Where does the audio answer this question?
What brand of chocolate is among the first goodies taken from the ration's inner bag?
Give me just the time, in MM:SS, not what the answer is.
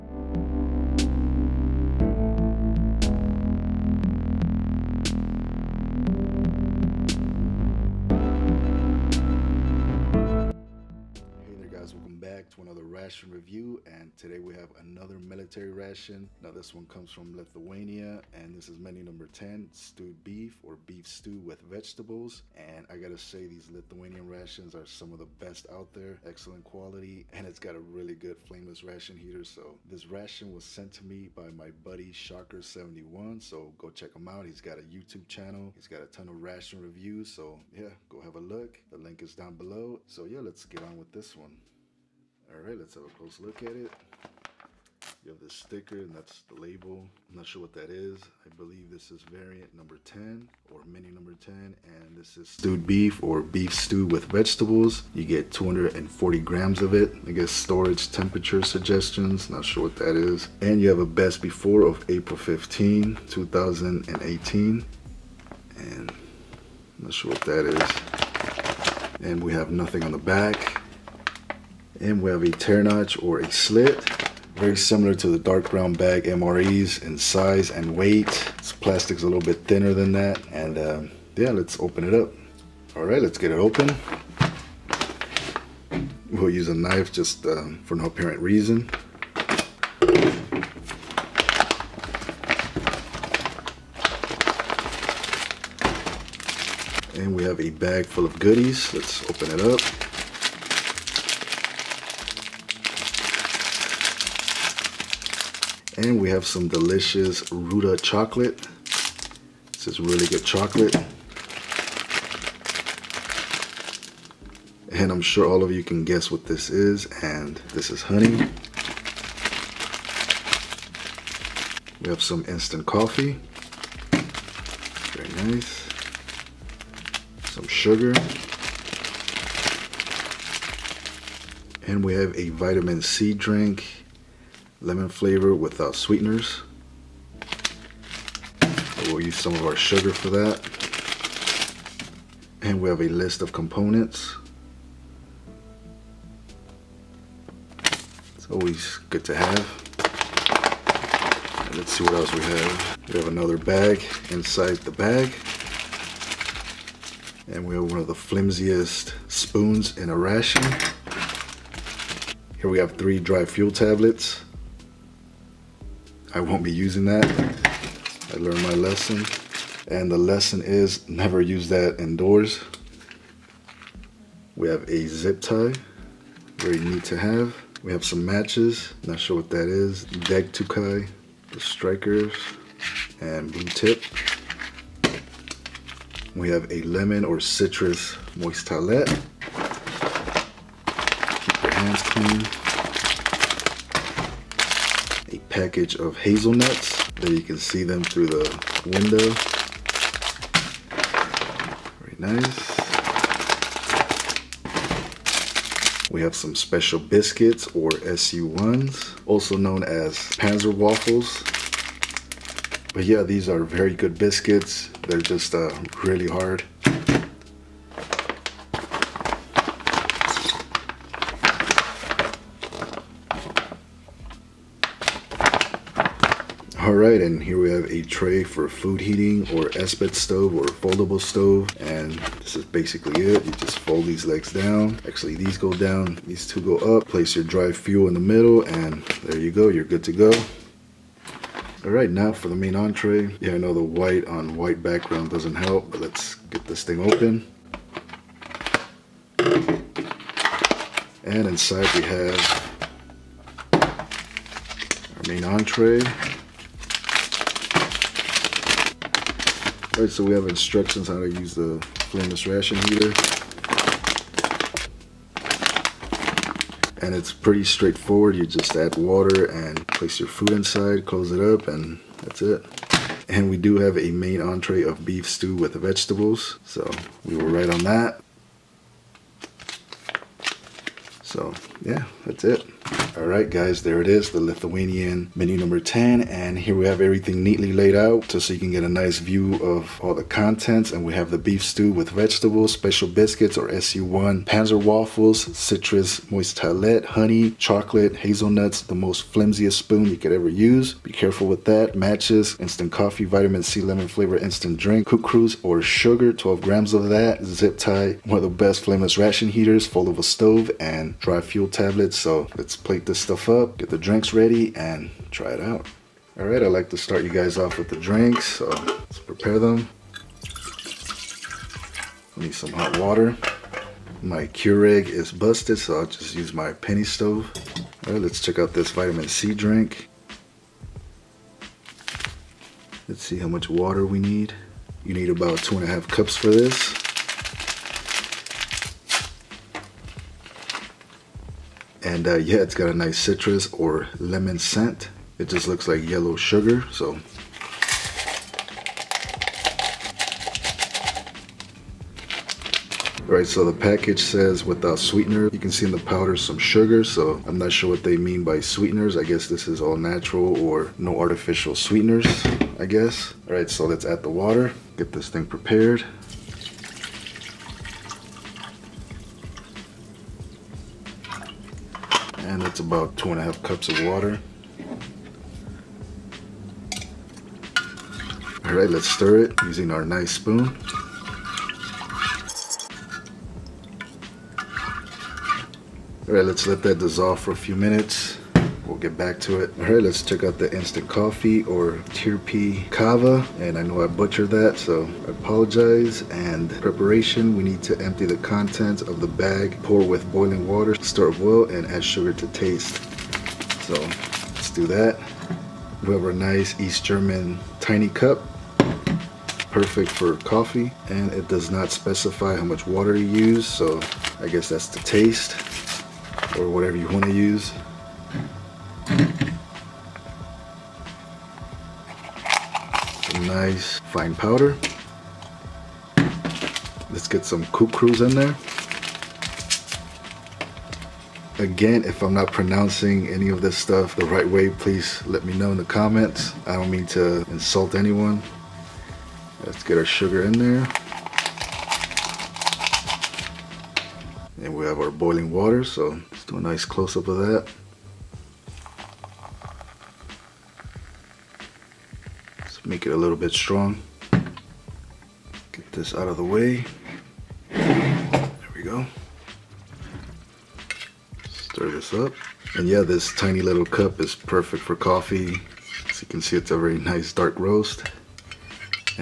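01:47.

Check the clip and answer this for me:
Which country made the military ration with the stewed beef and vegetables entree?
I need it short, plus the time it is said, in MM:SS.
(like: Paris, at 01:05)
Lithuania, at 00:17.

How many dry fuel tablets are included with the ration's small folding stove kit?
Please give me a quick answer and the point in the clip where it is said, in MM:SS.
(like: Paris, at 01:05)
3, at 02:42.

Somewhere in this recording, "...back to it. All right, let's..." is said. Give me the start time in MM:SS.
06:29.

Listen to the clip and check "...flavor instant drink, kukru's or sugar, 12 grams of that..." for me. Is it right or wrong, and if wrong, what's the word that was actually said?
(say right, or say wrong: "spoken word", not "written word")
right.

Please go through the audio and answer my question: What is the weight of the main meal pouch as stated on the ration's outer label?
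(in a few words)
240 grams.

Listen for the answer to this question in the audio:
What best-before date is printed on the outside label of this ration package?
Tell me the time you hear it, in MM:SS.
01:02.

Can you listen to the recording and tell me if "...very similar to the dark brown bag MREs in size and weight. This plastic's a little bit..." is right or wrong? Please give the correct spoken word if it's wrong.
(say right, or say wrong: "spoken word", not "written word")
right.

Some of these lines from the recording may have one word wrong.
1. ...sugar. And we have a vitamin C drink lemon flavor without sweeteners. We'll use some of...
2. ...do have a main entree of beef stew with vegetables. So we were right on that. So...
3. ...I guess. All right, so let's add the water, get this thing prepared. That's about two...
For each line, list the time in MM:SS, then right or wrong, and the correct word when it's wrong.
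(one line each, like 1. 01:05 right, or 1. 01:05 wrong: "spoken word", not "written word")
1. 02:07 right
2. 04:33 right
3. 06:02 right.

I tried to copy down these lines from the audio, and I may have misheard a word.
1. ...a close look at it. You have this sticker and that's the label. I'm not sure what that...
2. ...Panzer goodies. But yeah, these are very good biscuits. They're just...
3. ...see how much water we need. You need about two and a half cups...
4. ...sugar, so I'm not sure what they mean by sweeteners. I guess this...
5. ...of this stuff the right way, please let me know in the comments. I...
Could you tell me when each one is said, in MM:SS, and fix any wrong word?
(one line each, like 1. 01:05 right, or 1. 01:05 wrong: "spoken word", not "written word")
1. 00:43 right
2. 03:30 wrong: "waffles", not "goodies"
3. 05:33 right
4. 05:56 right
5. 07:13 right.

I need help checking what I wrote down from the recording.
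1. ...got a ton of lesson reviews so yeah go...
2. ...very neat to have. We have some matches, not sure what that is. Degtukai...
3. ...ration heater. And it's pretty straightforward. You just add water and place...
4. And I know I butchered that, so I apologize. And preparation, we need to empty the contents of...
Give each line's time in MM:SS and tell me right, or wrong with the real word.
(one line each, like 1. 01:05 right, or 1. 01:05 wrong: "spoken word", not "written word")
1. 00:35 wrong: "ration", not "lesson"
2. 02:56 right
3. 04:22 right
4. 06:33 right.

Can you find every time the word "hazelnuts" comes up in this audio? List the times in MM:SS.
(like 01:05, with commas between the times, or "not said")
03:16, 04:58.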